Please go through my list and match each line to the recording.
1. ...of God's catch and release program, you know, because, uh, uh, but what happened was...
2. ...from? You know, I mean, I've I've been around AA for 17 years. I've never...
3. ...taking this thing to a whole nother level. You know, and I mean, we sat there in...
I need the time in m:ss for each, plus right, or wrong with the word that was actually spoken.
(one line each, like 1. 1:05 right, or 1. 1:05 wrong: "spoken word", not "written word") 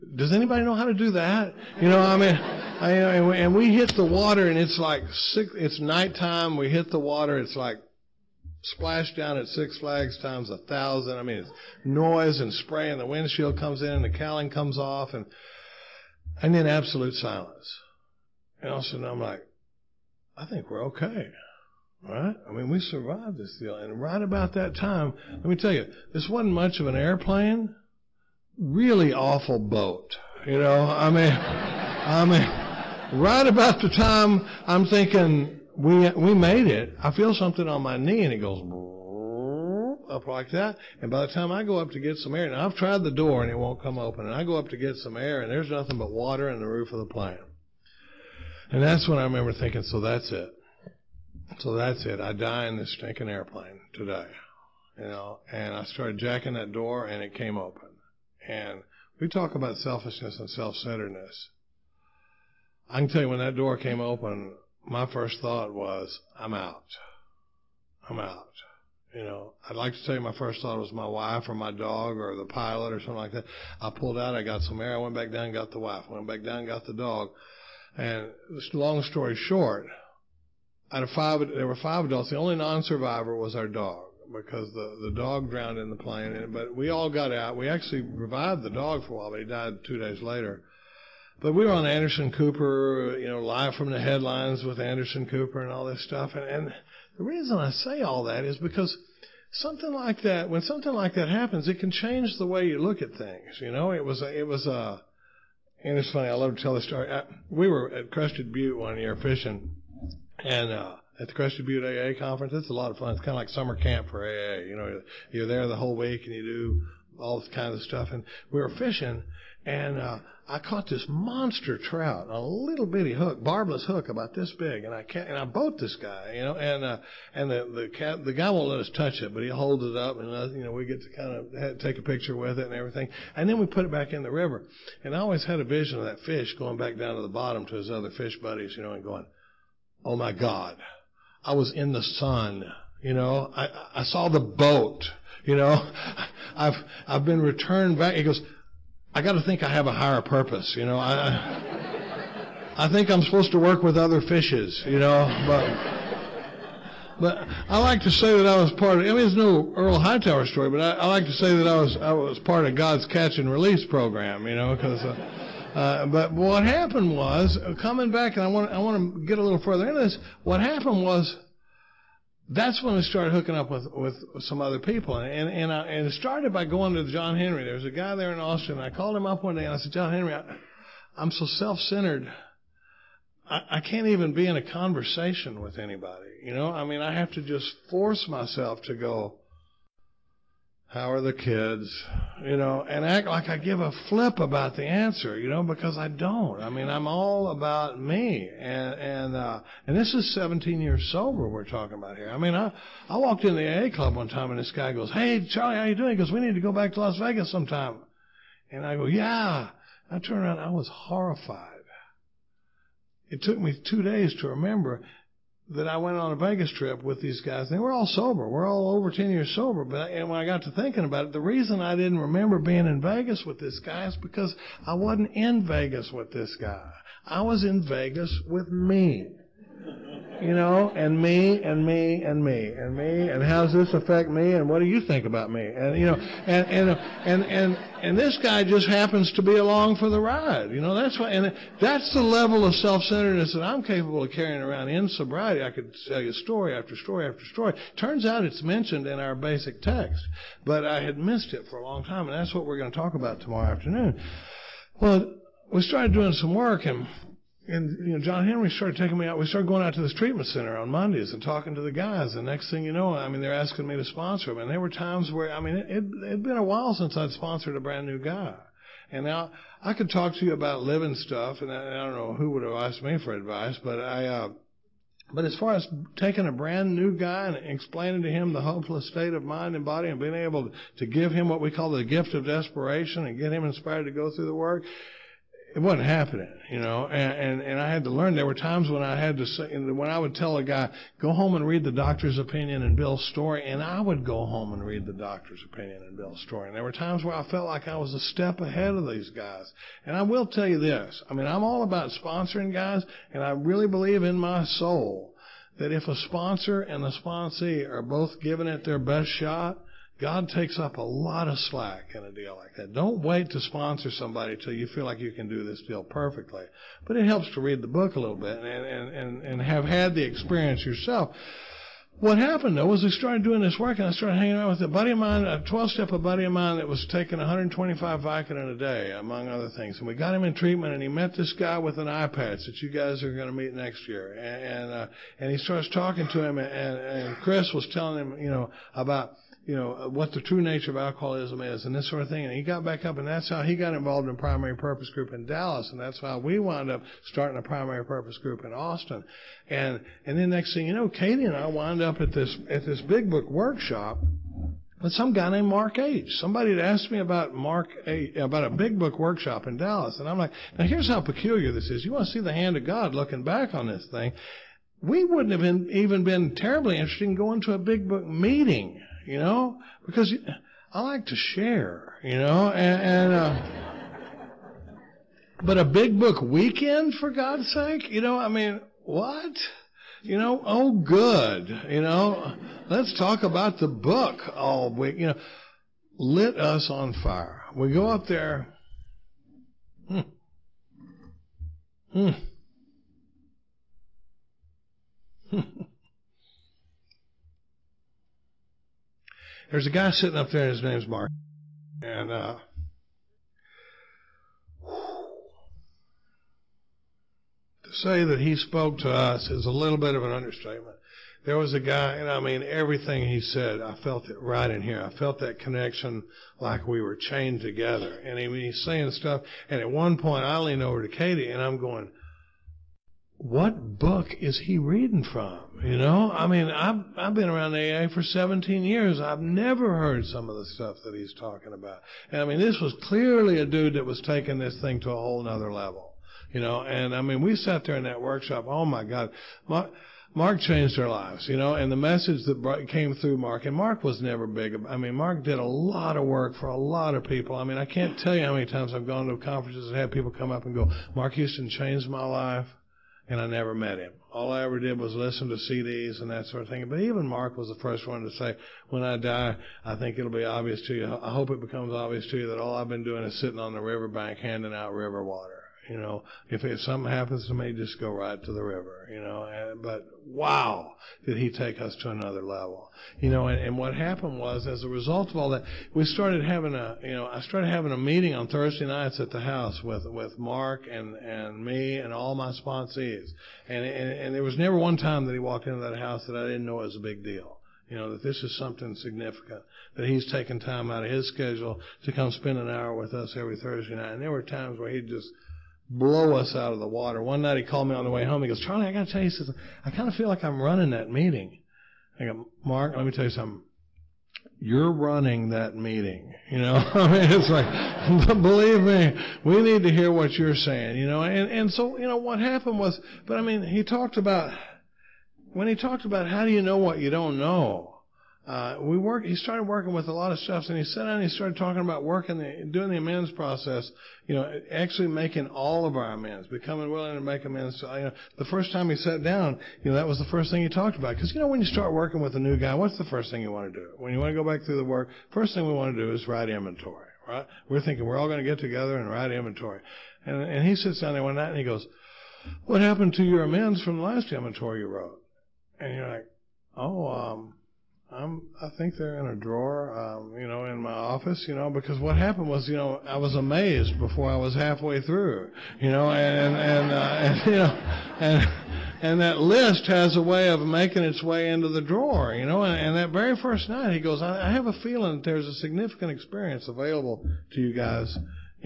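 1. 2:42 right
2. 7:05 right
3. 7:14 right.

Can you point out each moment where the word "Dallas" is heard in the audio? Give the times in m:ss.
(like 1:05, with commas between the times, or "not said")
5:45, 5:59.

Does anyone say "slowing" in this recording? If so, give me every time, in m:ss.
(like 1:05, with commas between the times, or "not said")
not said.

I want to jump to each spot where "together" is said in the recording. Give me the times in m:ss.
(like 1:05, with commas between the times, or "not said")
6:57, 8:58.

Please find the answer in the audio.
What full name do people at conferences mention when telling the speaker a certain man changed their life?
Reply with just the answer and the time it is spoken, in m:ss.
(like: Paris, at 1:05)
Mark Houston, at 7:31.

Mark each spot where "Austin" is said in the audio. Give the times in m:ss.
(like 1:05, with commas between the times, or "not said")
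2:58, 5:48.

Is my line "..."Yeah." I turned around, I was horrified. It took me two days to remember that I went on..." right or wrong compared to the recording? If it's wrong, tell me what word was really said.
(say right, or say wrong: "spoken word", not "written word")
right.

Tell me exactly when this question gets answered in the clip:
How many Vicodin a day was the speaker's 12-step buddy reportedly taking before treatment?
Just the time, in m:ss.
5:27.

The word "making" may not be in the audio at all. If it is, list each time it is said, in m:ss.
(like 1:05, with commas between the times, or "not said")
8:45, 9:20.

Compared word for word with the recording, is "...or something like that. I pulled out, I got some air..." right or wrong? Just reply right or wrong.
right.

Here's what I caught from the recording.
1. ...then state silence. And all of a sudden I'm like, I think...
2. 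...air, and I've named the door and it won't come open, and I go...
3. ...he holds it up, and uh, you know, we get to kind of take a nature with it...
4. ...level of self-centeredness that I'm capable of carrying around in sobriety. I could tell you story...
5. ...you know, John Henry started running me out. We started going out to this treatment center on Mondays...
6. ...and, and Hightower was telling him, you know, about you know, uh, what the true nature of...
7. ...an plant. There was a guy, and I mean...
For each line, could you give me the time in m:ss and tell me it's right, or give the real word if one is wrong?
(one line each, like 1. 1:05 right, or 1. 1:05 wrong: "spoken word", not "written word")
1. 0:16 wrong: "absolute", not "state"
2. 0:42 wrong: "tried", not "named"
3. 2:09 wrong: "picture", not "nature"
4. 4:02 right
5. 4:18 wrong: "taking", not "running"
6. 5:36 wrong: "Chris", not "Hightower"
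7. 6:50 wrong: "understatement", not "plant".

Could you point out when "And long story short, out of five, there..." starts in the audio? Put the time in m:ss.
1:17.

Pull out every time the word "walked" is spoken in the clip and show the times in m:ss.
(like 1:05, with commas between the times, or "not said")
3:23, 8:05.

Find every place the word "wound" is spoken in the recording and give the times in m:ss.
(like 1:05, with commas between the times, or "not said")
5:46, 5:51.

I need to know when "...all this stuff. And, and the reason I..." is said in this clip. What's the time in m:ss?
1:35.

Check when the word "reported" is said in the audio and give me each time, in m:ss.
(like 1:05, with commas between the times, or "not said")
not said.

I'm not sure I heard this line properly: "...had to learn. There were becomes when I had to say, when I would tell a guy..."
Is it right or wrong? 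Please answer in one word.
wrong.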